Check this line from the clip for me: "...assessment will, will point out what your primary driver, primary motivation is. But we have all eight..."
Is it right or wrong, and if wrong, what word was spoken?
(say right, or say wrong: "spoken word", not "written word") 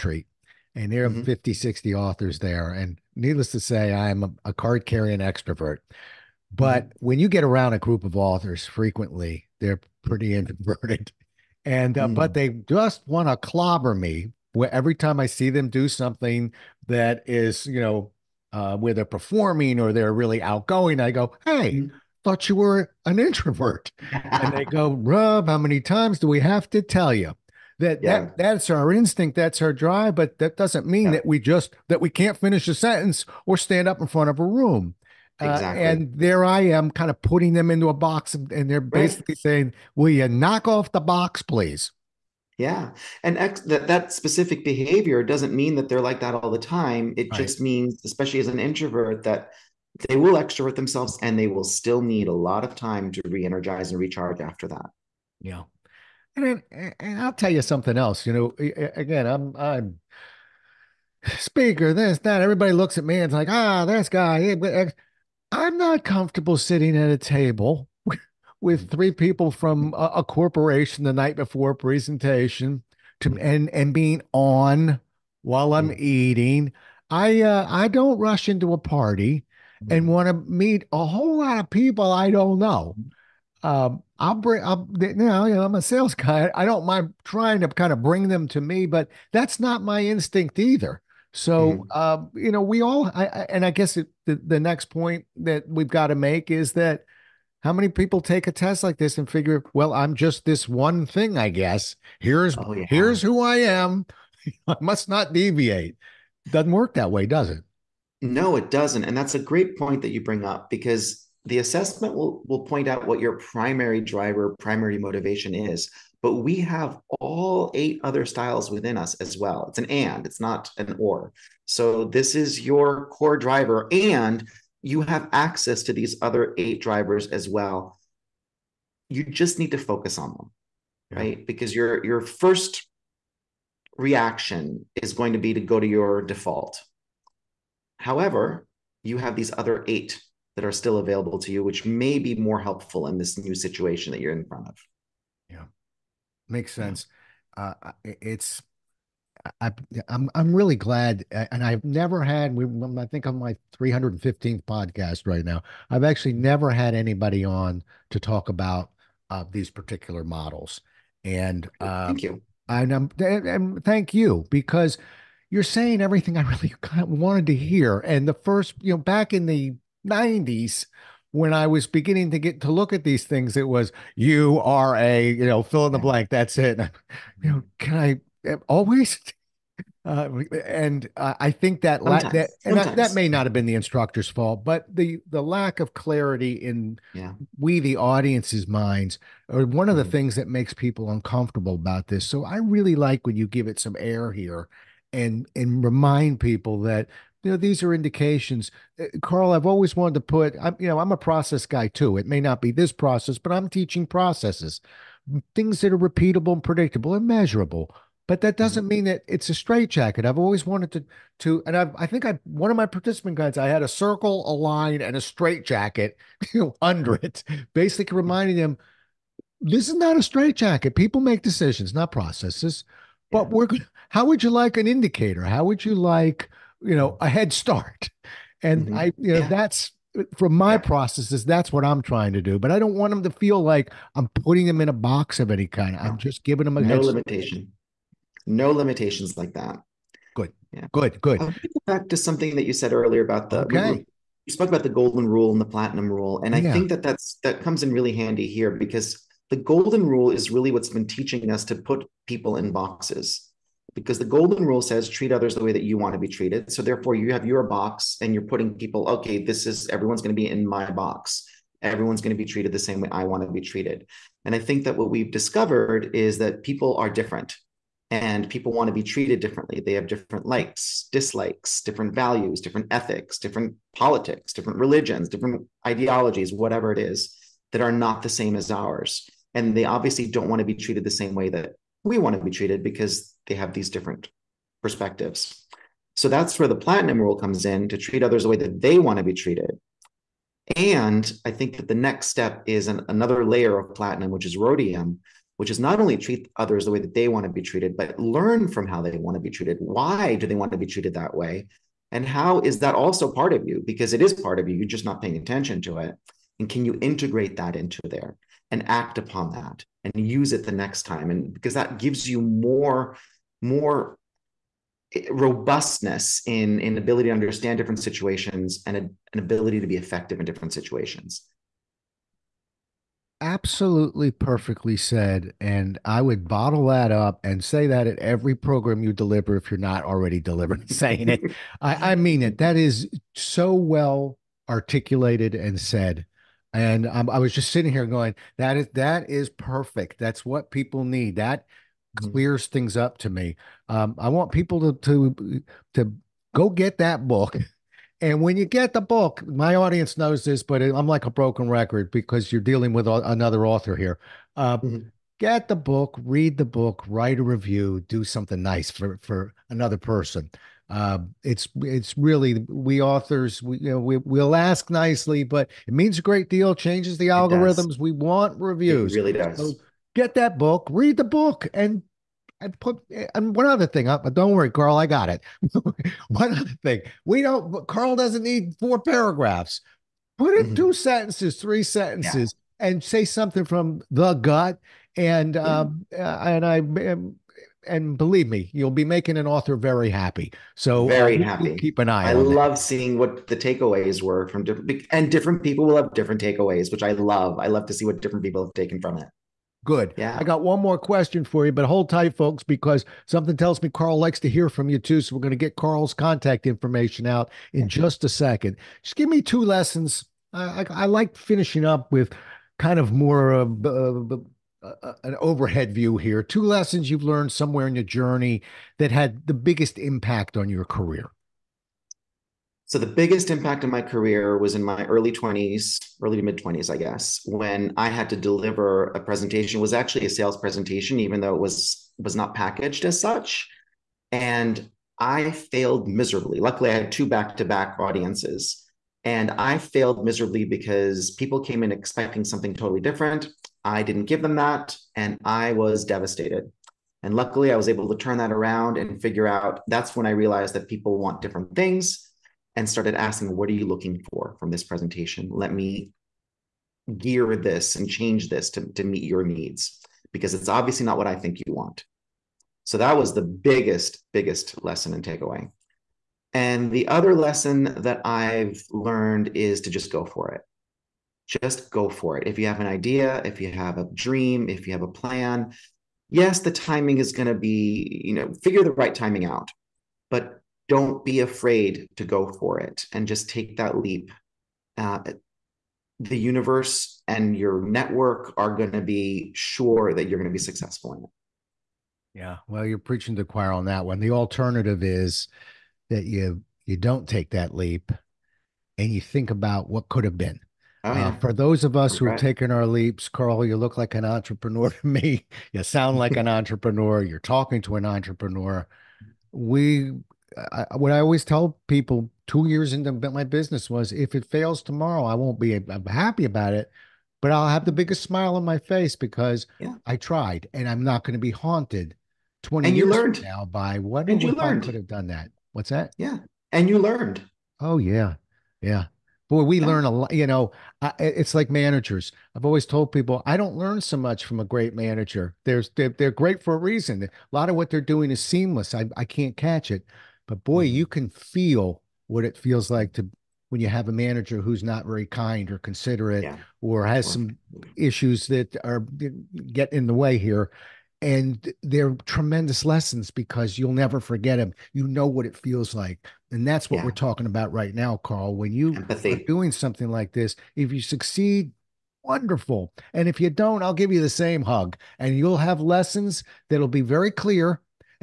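right.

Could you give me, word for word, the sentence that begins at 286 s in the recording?
So that's where the platinum rule comes in to treat others the way that they want to be treated.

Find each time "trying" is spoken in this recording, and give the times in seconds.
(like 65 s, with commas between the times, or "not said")
87 s, 232 s.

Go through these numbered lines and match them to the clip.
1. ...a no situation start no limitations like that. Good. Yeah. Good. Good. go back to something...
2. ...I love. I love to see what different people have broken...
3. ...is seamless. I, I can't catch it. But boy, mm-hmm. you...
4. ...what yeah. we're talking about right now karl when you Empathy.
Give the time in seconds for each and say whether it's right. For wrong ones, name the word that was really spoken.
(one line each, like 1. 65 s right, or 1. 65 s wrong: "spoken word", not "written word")
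1. 236 s wrong: "limitation", not "situation"
2. 397 s wrong: "taken", not "broken"
3. 538 s right
4. 556 s right.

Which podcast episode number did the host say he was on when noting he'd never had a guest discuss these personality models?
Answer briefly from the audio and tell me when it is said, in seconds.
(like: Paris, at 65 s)
315th, at 153 s.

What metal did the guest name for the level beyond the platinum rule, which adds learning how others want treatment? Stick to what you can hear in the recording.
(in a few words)
rhodium.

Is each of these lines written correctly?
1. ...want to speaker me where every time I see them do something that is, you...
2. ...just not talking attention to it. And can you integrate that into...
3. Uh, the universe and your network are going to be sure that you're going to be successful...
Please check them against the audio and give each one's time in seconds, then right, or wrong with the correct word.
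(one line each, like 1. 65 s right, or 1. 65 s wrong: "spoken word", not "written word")
1. 13 s wrong: "clobber", not "speaker"
2. 304 s wrong: "paying", not "talking"
3. 484 s right.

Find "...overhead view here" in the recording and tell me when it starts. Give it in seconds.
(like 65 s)
415 s.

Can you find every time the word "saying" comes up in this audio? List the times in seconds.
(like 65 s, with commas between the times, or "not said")
39 s, 165 s, 330 s.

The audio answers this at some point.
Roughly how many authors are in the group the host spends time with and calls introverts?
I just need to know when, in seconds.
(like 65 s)
1 s.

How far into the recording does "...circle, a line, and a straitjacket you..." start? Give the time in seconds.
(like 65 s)
213 s.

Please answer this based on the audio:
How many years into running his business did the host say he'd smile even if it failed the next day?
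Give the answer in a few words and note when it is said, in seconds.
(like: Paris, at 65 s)
2, at 512 s.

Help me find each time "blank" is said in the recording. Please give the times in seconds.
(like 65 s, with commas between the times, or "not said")
175 s.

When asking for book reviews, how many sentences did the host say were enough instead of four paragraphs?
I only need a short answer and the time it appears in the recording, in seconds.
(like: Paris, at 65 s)
2 or 3, at 380 s.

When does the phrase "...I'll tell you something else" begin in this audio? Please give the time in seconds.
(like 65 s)
57 s.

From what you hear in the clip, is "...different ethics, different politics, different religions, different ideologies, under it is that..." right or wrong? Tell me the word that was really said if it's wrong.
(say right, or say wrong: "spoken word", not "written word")
wrong: "whatever", not "under".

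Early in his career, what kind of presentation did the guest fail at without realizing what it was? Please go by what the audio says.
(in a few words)
a sales presentation.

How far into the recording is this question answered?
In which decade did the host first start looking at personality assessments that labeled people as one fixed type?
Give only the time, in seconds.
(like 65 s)
169 s.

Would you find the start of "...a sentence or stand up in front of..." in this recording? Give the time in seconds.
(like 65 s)
32 s.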